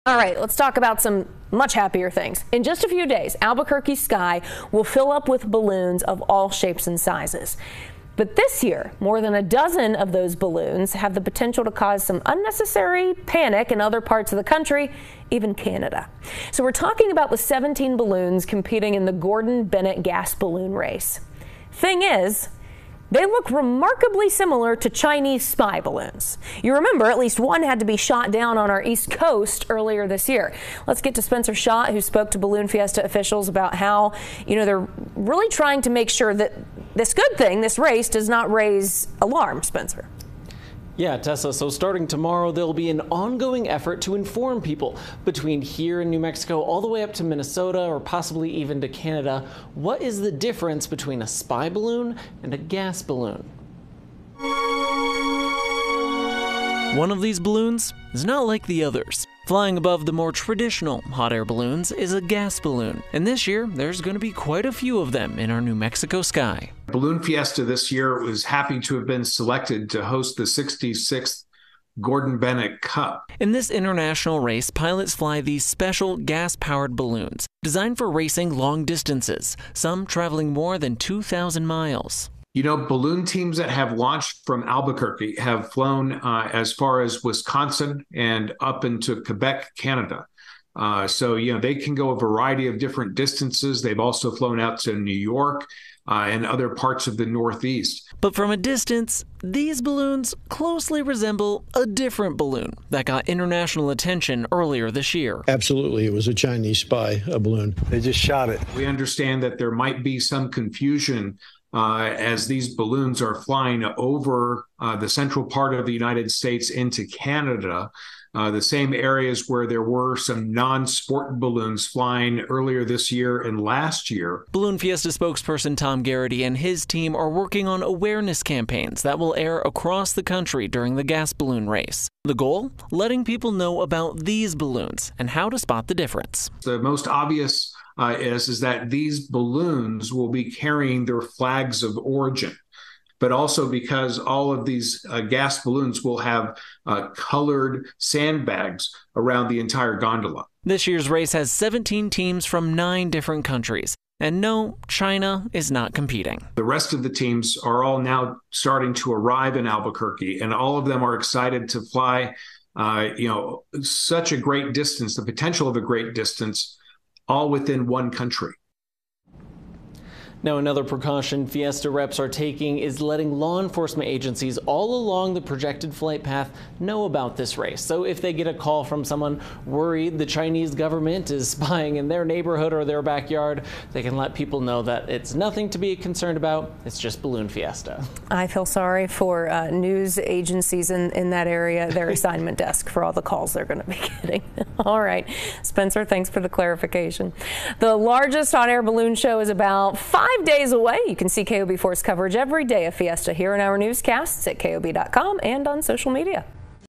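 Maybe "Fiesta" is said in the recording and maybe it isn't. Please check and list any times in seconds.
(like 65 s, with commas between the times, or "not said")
32 s, 67 s, 124 s, 171 s, 187 s, 202 s.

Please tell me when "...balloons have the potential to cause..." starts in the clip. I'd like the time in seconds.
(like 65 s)
10 s.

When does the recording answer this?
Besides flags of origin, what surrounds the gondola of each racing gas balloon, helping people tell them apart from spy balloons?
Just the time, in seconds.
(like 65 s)
147 s.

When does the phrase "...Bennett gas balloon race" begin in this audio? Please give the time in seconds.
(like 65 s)
19 s.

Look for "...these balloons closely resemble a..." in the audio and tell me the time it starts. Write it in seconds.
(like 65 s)
99 s.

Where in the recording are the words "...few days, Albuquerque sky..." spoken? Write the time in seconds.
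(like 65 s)
2 s.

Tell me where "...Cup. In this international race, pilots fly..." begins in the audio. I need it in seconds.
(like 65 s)
72 s.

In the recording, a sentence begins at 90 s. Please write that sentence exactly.
Uh, so, you know, they can go a variety of different distances.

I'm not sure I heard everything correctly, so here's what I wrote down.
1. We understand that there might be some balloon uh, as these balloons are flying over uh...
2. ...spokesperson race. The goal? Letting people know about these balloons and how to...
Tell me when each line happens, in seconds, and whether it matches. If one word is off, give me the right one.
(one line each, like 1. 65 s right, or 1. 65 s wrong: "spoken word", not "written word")
1. 108 s wrong: "confusion", not "balloon"
2. 131 s wrong: "balloon", not "spokesperson".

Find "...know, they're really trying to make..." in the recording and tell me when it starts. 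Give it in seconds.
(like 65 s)
34 s.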